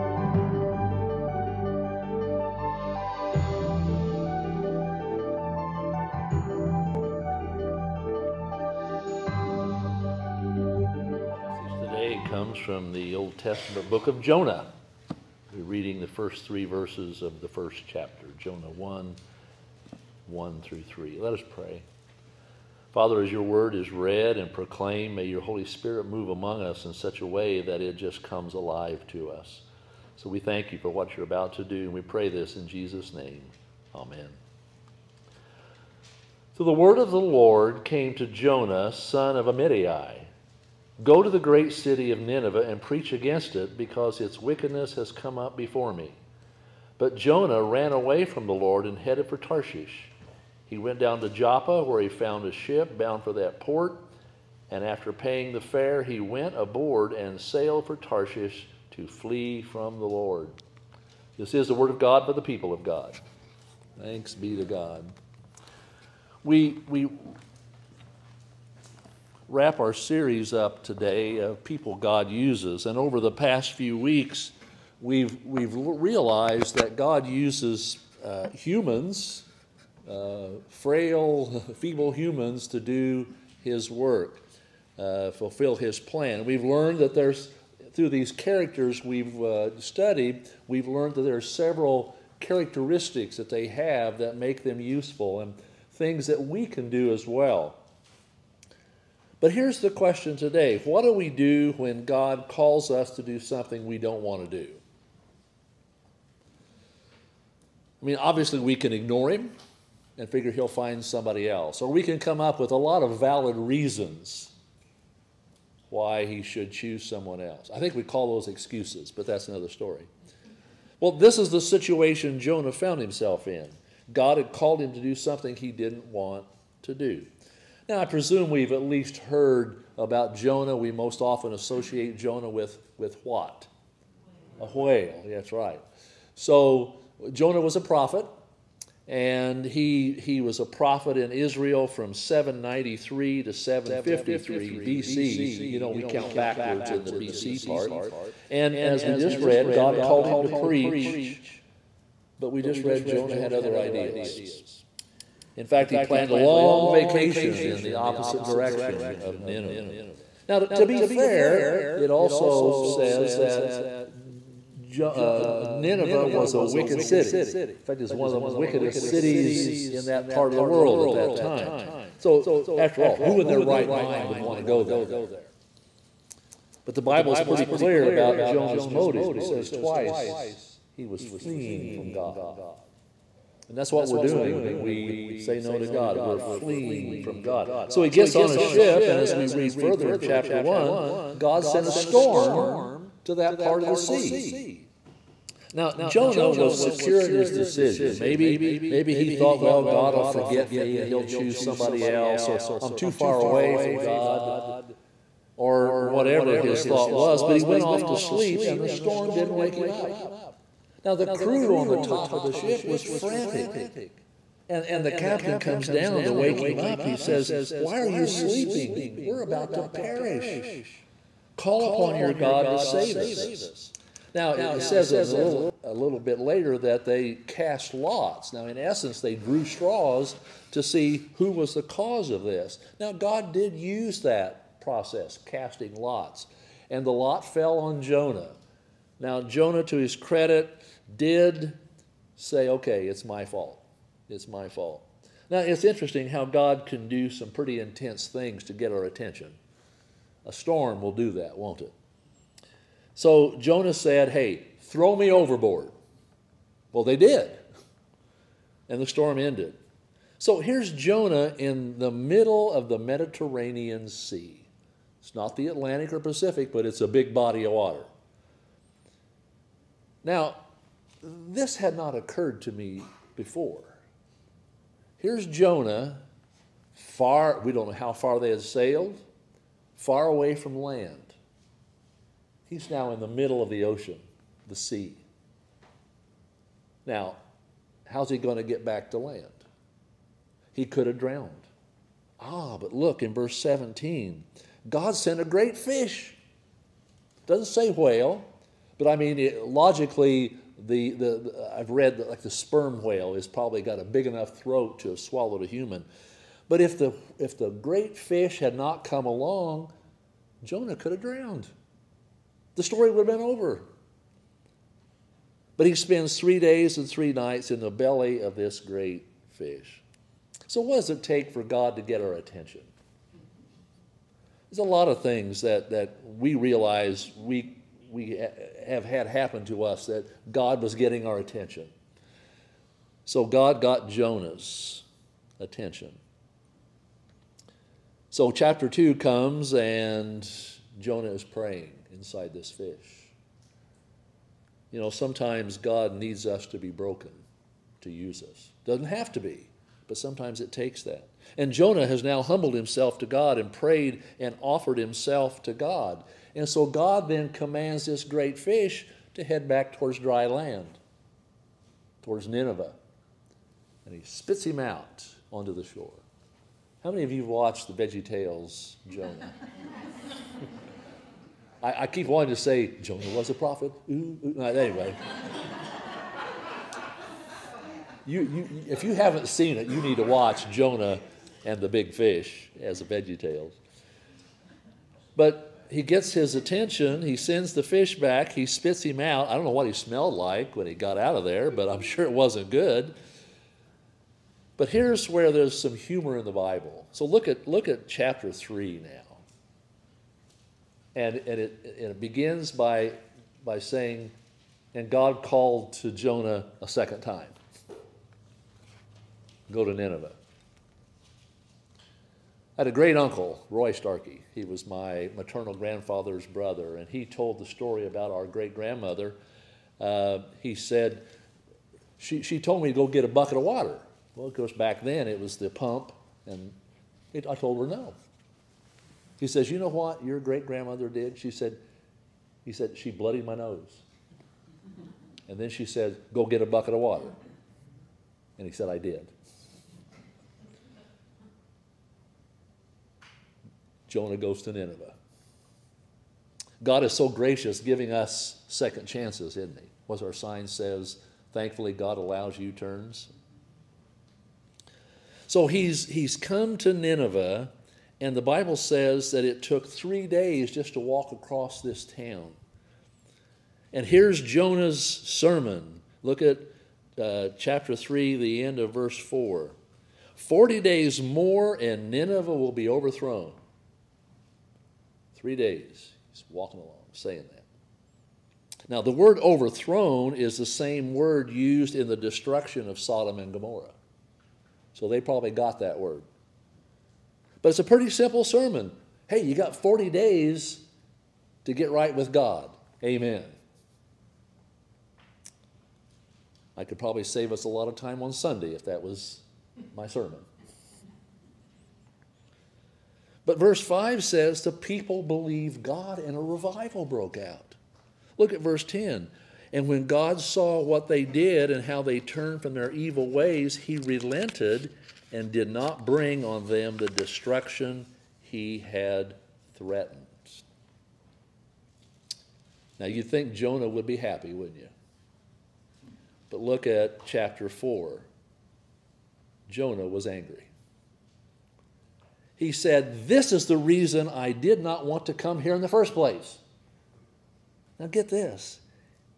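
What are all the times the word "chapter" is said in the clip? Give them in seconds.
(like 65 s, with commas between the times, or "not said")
17 s, 190 s, 338 s, 398 s, 467 s, 527 s.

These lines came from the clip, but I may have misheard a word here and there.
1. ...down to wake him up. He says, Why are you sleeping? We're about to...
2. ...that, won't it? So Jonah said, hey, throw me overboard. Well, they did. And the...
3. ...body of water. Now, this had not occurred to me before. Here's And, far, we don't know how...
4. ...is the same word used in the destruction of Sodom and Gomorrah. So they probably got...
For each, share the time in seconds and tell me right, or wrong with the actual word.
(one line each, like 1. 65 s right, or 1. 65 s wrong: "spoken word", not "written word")
1. 215 s right
2. 251 s right
3. 267 s wrong: "Jonah", not "And"
4. 480 s right.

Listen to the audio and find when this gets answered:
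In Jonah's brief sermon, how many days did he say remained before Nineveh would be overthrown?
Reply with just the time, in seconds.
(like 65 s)
470 s.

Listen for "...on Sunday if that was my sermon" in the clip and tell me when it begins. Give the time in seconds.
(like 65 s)
498 s.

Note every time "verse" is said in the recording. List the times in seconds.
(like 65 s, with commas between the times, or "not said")
16 s, 293 s, 468 s, 503 s, 508 s.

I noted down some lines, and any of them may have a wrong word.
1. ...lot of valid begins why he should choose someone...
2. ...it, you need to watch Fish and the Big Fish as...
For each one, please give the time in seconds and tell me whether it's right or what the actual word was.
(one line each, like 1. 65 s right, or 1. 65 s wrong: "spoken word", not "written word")
1. 112 s wrong: "reasons", not "begins"
2. 379 s wrong: "Jonah", not "Fish".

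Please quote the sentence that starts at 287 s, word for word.
Now, how's he going to get back to land?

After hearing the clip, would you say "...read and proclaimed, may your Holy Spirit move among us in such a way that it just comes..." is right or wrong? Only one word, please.
right.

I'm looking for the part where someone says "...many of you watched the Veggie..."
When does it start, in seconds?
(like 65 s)
367 s.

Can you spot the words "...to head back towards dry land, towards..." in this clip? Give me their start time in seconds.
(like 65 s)
359 s.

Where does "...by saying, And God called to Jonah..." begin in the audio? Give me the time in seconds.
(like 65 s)
403 s.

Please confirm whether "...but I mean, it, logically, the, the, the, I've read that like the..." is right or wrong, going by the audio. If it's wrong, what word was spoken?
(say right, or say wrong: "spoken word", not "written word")
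right.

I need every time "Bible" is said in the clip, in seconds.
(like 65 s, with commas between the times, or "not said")
177 s, 396 s, 458 s.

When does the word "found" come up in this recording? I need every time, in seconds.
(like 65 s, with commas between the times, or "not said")
52 s, 122 s.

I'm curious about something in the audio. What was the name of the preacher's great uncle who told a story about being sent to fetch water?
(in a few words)
Roy Starkey.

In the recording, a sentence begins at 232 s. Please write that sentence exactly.
Now, God did use that process, casting lots, and the lot fell on Jonah.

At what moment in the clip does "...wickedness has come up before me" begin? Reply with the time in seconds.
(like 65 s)
44 s.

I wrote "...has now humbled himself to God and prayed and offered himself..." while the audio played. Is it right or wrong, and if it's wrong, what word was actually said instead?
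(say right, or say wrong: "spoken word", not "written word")
right.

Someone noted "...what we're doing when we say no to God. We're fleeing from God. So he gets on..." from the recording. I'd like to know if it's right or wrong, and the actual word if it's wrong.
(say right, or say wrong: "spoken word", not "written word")
right.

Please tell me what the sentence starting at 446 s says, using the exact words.
God is so gracious giving us second chances, isn't he?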